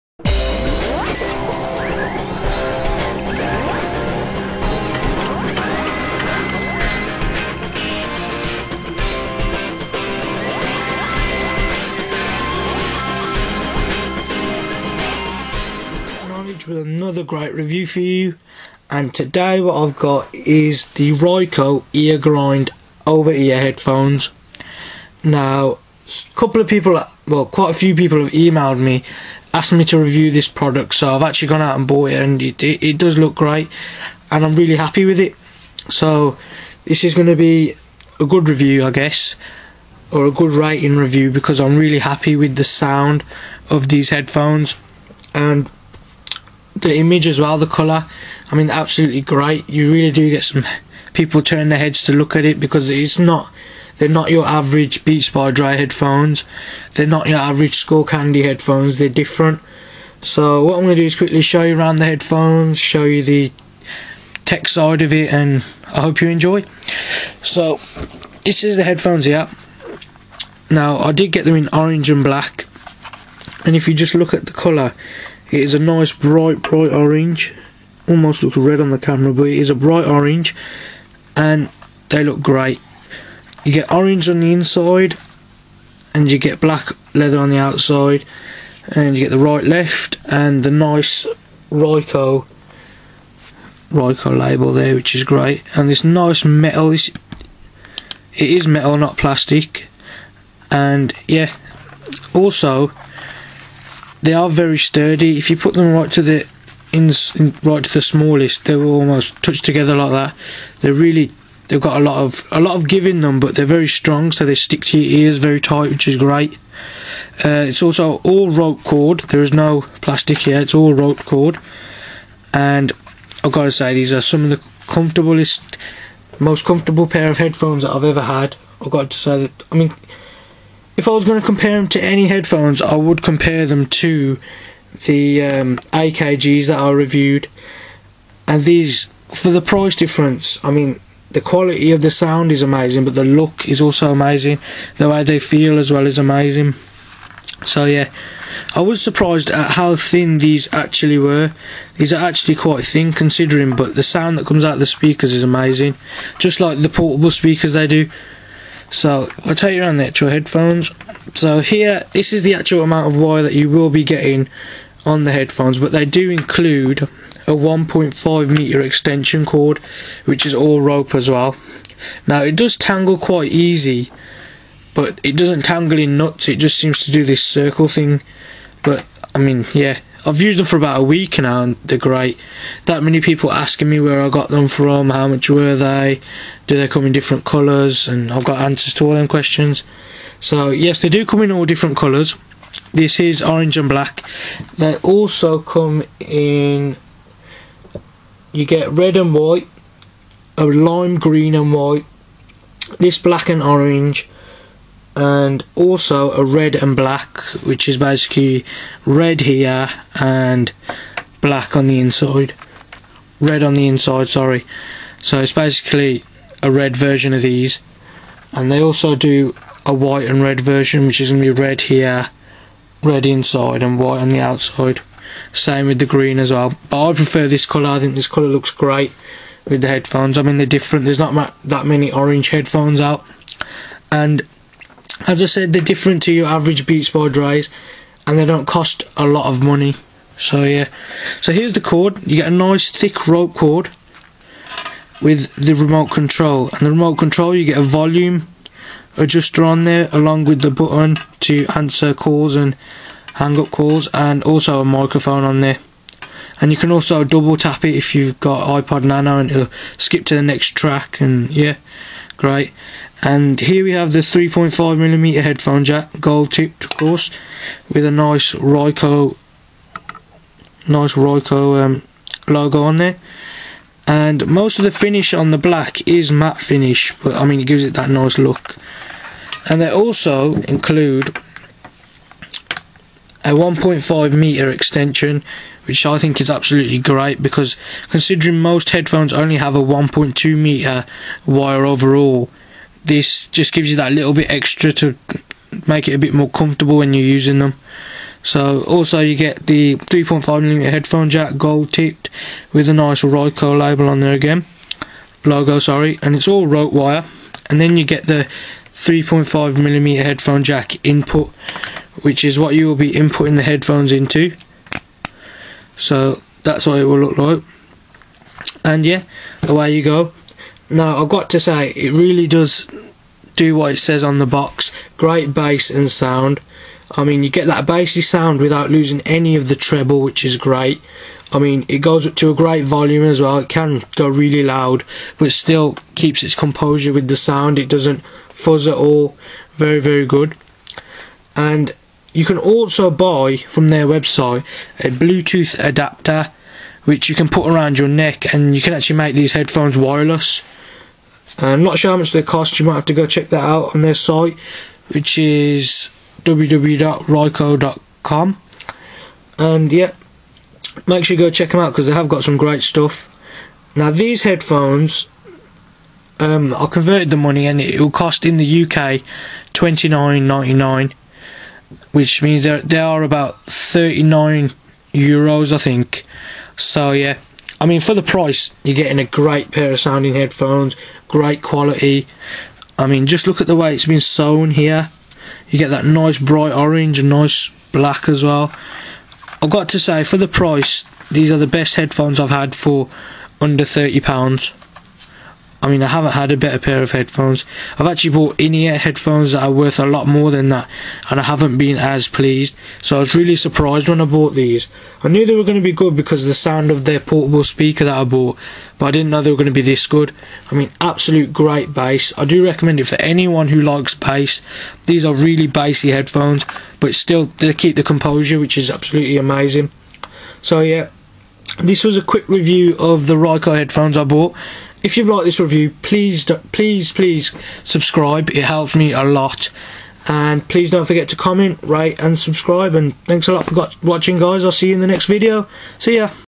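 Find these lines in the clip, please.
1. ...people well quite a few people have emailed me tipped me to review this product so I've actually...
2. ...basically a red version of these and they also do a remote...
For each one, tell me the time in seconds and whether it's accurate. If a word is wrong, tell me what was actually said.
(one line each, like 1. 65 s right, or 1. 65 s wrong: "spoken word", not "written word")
1. 26 s wrong: "asked", not "tipped"
2. 215 s wrong: "white", not "remote".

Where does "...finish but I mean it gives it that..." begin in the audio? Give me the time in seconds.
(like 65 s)
276 s.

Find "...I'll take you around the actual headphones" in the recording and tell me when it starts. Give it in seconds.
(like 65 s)
159 s.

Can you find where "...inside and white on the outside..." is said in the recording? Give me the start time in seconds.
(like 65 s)
223 s.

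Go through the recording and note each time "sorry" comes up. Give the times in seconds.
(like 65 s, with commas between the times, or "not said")
214 s, 305 s.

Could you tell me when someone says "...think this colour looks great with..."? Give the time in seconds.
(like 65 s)
227 s.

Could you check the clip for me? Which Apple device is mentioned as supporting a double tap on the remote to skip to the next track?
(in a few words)
iPod Nano.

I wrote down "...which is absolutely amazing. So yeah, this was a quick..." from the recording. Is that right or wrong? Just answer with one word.
right.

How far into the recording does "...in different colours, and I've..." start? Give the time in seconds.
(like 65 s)
187 s.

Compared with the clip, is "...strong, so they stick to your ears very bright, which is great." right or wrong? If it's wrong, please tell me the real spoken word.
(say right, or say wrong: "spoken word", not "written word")
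wrong: "tight", not "bright".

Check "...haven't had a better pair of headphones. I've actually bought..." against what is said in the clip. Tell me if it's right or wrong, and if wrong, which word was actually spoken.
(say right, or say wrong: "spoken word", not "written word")
right.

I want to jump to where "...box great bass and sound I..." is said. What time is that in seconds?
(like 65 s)
324 s.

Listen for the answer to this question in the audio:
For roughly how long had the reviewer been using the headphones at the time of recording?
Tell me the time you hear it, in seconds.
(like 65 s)
180 s.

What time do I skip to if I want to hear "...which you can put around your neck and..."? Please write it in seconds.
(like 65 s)
347 s.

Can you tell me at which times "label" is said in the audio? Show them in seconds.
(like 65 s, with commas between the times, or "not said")
94 s, 303 s.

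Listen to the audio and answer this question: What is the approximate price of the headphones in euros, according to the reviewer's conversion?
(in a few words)
39 euros.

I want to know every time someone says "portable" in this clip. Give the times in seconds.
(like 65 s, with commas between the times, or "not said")
156 s, 407 s.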